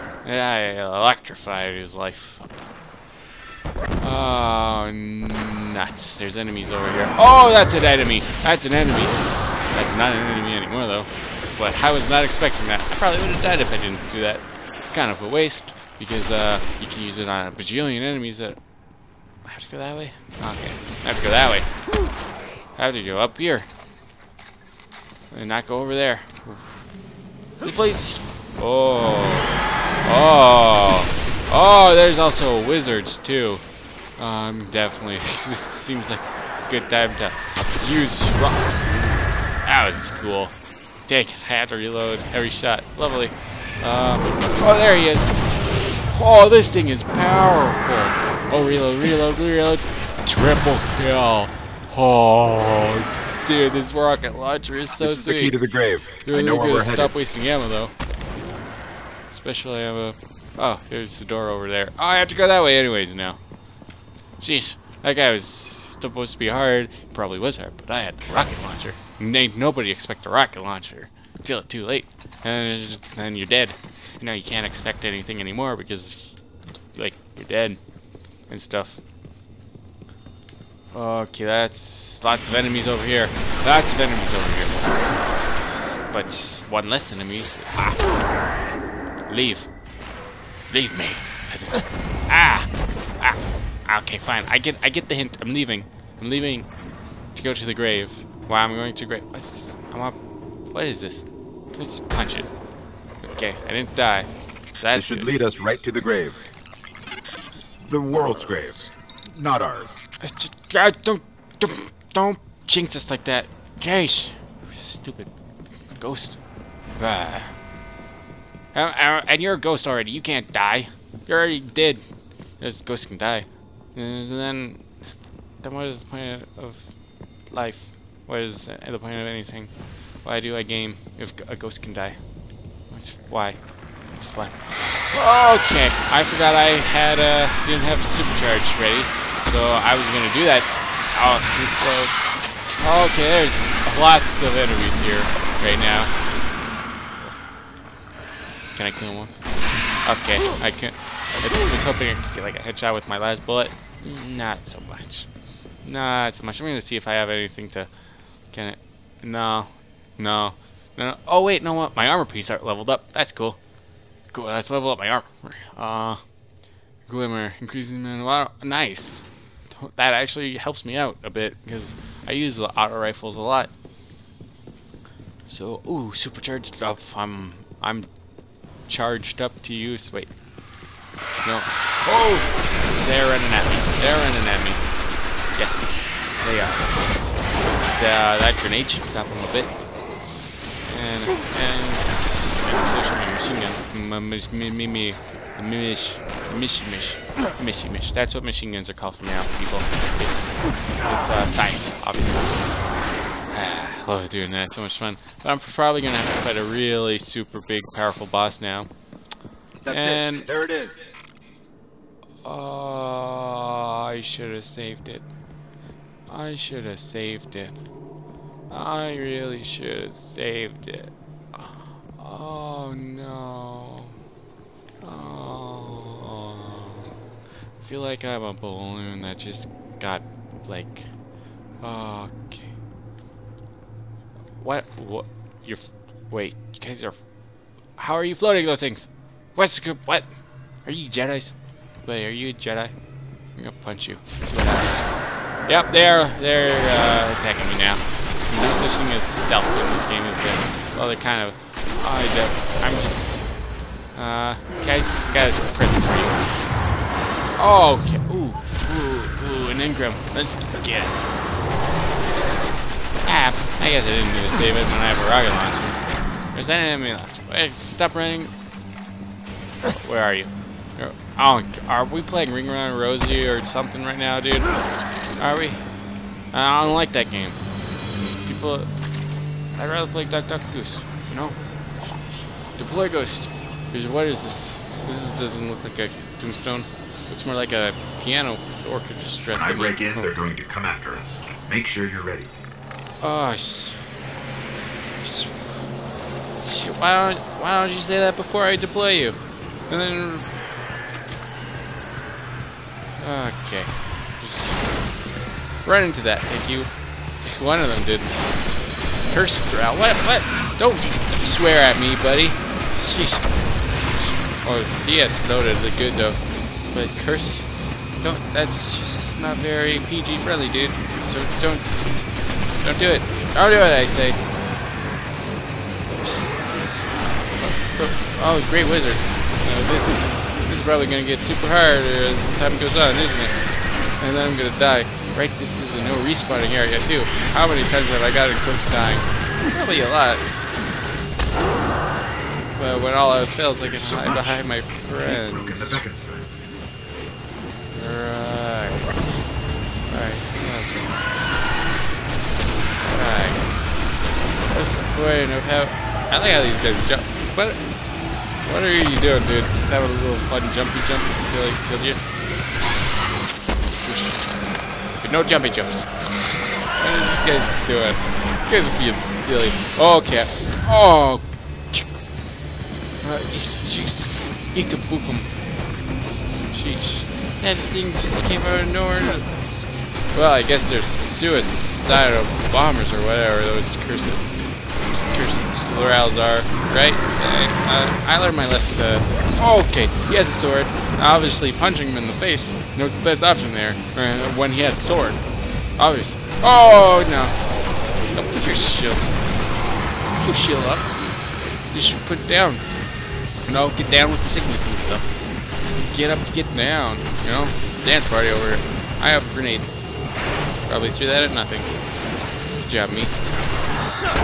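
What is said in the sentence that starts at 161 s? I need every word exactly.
My armor pieces aren't leveled up.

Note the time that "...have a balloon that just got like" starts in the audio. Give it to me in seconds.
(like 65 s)
228 s.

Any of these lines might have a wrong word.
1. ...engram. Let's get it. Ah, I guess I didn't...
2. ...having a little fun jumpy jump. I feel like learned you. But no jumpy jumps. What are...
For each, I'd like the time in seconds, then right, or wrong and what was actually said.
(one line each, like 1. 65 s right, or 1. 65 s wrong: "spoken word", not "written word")
1. 259 s right
2. 359 s wrong: "killed", not "learned".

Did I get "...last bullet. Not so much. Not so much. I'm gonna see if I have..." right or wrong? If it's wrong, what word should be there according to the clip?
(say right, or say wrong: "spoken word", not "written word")
right.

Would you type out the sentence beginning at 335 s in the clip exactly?
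Right, this is a no respawning area too.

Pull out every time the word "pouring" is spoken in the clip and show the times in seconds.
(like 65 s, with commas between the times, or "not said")
not said.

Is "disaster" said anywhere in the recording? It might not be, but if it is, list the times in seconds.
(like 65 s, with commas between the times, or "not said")
not said.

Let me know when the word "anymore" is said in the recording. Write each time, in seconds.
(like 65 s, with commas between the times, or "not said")
10 s, 75 s.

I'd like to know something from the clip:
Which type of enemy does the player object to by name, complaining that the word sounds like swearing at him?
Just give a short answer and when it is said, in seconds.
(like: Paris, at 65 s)
Cursed Thrall, at 309 s.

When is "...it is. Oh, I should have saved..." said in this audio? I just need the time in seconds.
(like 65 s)
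210 s.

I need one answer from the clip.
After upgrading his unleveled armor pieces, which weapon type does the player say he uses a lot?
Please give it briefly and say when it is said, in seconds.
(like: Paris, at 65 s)
auto rifles, at 172 s.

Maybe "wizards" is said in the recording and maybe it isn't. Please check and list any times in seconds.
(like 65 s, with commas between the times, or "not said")
32 s, 328 s.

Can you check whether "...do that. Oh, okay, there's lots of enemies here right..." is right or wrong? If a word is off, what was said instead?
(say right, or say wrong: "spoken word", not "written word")
right.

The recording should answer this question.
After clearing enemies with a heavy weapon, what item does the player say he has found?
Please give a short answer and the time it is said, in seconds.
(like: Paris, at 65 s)
the key to the grave, at 55 s.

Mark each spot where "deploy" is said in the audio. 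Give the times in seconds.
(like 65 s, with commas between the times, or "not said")
282 s, 298 s.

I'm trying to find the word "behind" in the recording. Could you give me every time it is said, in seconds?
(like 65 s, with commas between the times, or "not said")
344 s.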